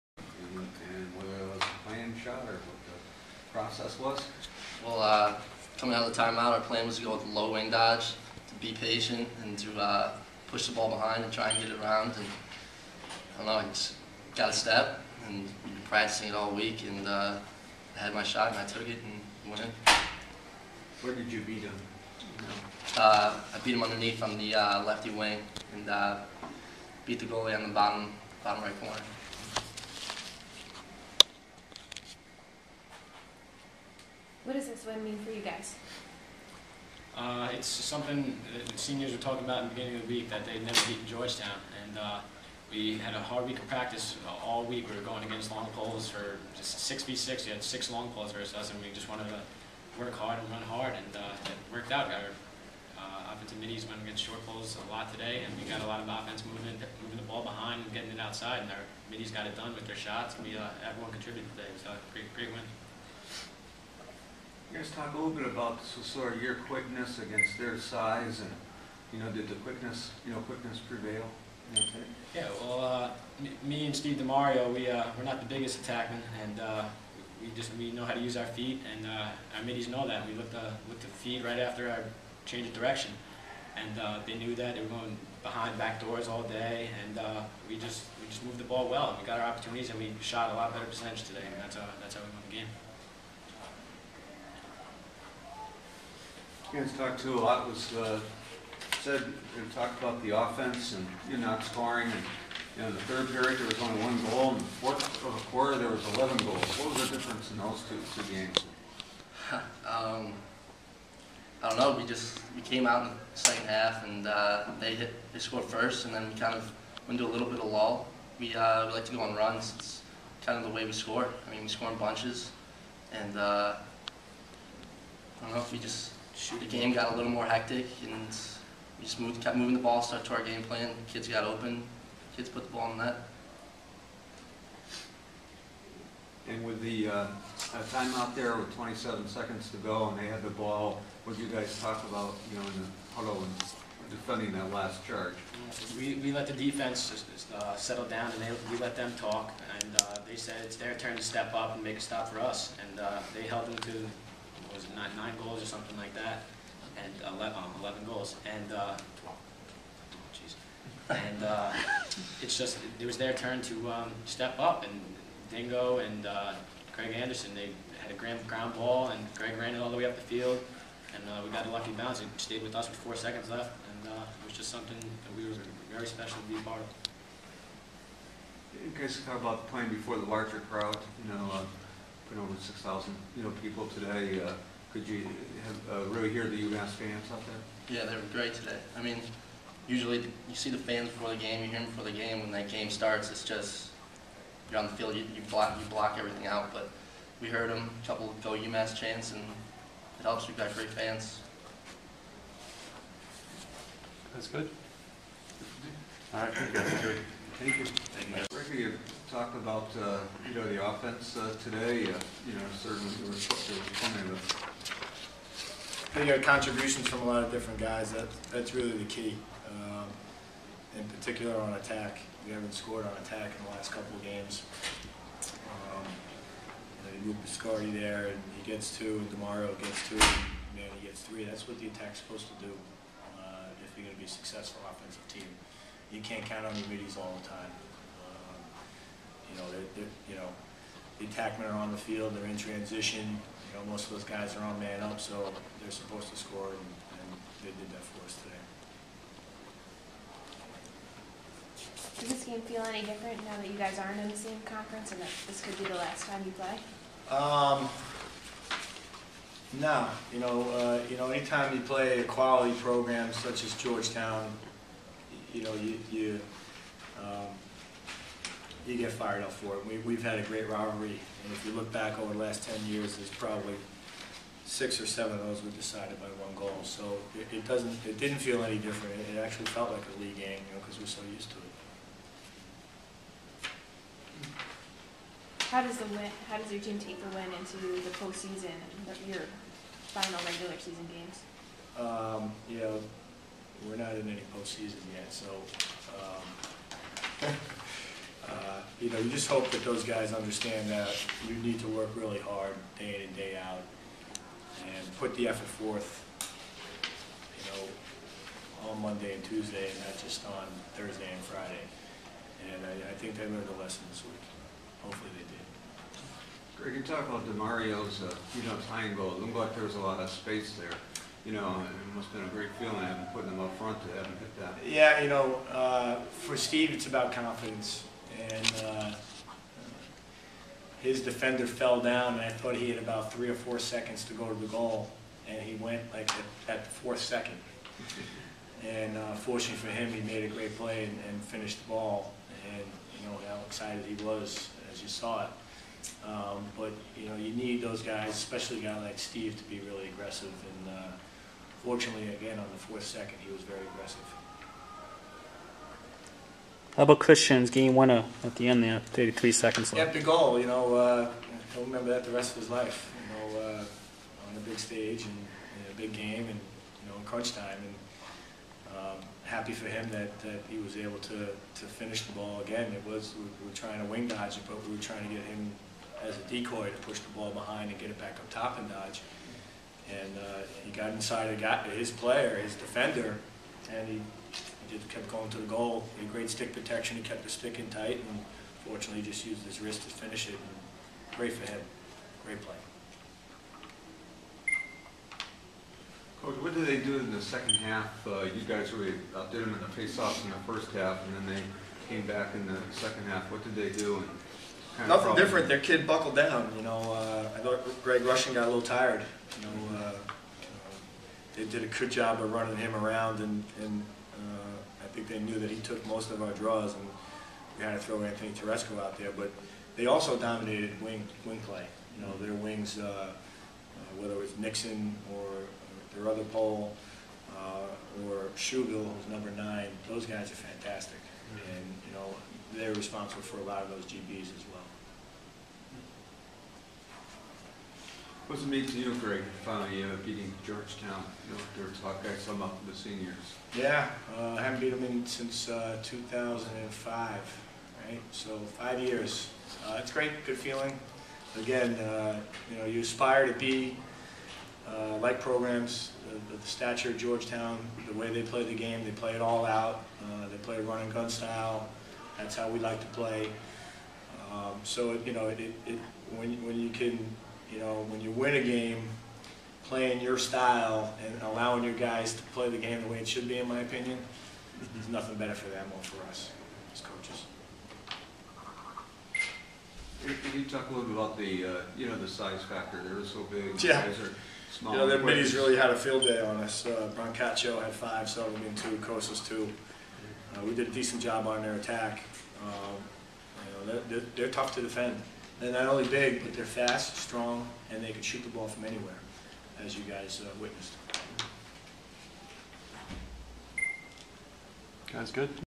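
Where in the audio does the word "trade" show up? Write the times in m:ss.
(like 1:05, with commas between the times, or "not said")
not said.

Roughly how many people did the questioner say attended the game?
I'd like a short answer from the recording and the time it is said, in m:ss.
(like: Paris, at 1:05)
Over 6,000, at 3:02.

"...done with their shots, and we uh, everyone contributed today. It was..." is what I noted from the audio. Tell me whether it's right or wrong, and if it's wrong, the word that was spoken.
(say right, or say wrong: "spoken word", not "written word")
right.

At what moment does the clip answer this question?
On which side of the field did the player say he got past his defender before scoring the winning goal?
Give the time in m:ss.
0:24.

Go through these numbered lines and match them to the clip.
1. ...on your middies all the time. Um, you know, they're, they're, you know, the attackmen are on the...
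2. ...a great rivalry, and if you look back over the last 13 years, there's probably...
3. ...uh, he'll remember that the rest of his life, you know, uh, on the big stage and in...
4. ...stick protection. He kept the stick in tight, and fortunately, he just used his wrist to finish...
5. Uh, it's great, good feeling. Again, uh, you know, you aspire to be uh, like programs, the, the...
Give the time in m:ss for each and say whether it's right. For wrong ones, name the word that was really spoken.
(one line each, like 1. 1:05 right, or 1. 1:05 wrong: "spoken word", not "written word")
1. 3:56 right
2. 4:30 wrong: "10", not "13"
3. 6:00 right
4. 6:26 right
5. 7:29 right.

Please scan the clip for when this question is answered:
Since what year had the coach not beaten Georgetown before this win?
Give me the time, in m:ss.
7:26.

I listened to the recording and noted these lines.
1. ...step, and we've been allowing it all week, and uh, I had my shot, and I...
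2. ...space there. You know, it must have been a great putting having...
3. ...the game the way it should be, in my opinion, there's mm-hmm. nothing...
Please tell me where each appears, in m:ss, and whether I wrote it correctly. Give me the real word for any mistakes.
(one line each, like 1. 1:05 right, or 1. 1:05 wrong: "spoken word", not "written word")
1. 0:14 wrong: "practicing", not "allowing"
2. 5:20 wrong: "feeling", not "putting"
3. 7:52 right.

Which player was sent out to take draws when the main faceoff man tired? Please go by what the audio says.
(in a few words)
Anthony Teresco.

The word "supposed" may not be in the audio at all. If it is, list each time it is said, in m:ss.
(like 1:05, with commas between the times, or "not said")
3:52, 4:05.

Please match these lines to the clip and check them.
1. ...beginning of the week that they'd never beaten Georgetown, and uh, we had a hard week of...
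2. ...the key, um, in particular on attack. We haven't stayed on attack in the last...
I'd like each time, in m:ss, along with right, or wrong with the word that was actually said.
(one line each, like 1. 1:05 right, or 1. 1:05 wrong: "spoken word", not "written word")
1. 0:39 right
2. 3:38 wrong: "scored", not "stayed".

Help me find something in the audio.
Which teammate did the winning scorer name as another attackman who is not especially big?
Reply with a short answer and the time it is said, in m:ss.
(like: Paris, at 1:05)
Steve DeMario, at 1:13.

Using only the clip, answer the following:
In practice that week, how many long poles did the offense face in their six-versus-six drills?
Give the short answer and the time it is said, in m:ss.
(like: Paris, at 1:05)
6, at 0:47.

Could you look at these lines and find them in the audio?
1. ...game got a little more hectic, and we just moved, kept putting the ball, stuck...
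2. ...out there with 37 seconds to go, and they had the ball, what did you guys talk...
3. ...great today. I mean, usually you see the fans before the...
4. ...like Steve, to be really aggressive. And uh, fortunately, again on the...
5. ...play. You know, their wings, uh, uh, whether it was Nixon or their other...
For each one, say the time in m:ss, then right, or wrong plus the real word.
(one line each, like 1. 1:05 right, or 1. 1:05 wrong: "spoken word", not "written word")
1. 2:06 wrong: "moving", not "putting"
2. 2:18 wrong: "27", not "37"
3. 3:08 right
4. 5:49 right
5. 7:01 right.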